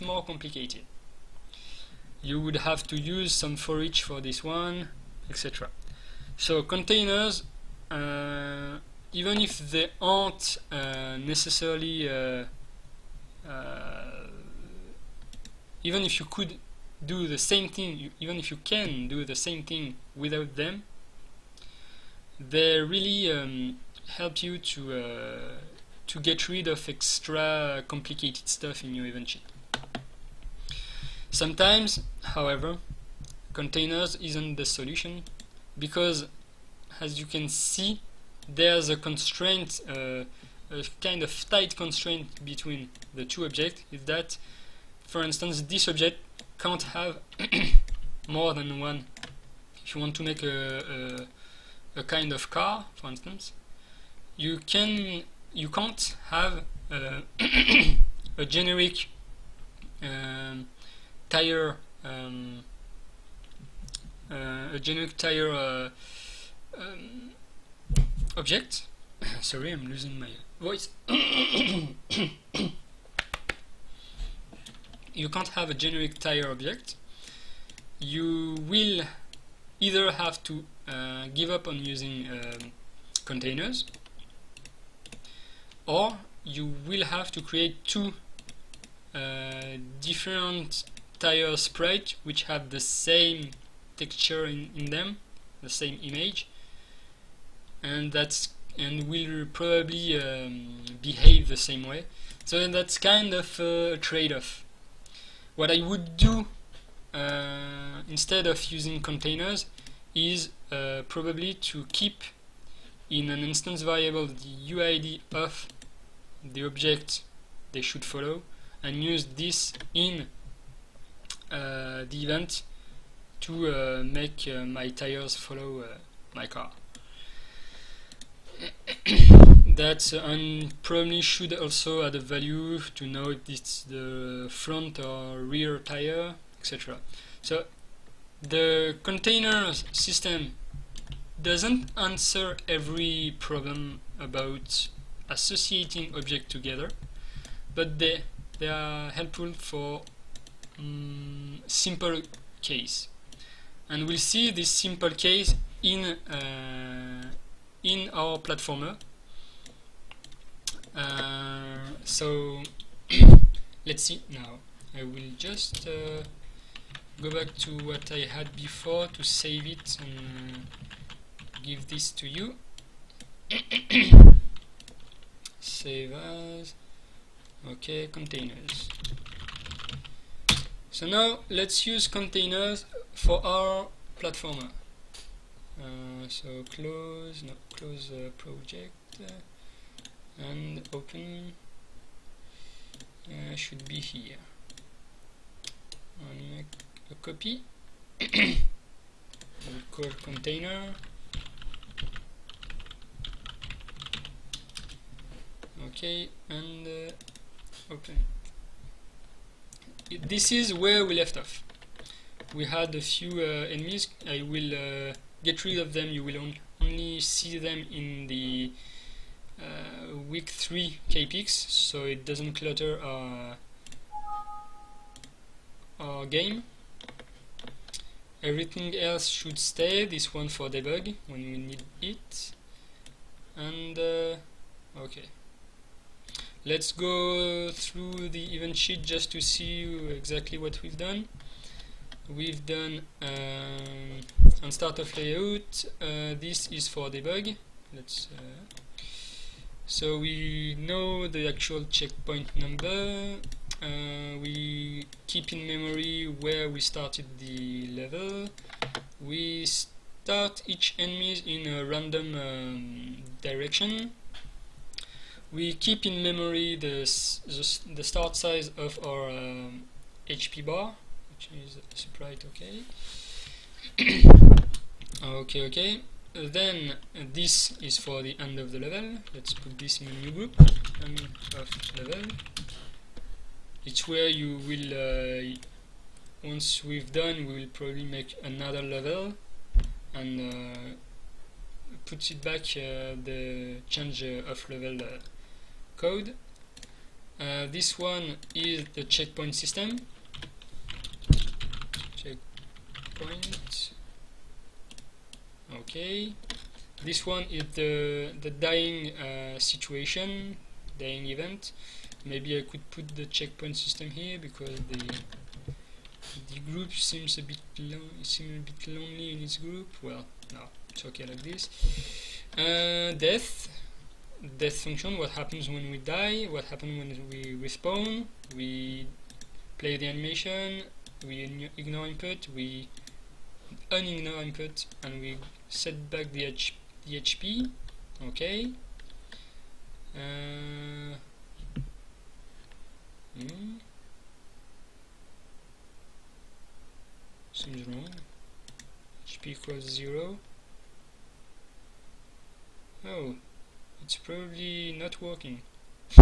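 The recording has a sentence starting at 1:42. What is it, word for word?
So that's kind of a trade-off.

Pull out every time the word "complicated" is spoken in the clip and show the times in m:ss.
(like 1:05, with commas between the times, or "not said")
0:00, 0:27.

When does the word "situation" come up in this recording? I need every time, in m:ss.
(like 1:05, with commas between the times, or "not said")
5:09.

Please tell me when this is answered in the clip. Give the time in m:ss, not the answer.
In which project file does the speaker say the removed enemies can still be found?
3:40.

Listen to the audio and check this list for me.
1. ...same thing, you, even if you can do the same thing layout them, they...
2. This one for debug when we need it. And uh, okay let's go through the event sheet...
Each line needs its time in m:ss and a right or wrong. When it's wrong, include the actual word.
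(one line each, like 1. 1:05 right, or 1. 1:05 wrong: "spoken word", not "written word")
1. 0:17 wrong: "without", not "layout"
2. 3:50 right.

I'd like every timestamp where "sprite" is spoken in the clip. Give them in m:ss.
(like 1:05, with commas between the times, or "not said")
1:31, 4:31.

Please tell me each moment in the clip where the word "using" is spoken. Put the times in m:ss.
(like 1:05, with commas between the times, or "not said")
1:21, 1:48.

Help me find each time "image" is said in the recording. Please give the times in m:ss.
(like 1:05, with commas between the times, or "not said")
1:36.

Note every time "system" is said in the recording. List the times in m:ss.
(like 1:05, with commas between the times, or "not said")
2:19, 4:59, 5:13.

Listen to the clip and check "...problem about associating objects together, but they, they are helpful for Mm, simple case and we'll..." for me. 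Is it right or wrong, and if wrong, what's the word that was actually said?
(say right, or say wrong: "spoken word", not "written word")
right.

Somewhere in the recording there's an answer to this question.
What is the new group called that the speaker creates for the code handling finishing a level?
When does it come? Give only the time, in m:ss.
4:41.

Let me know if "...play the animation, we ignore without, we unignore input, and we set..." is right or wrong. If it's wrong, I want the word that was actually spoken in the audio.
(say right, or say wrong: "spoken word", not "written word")
wrong: "input", not "without".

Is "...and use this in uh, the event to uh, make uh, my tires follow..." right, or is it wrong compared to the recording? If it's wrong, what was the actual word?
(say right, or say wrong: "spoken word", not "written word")
right.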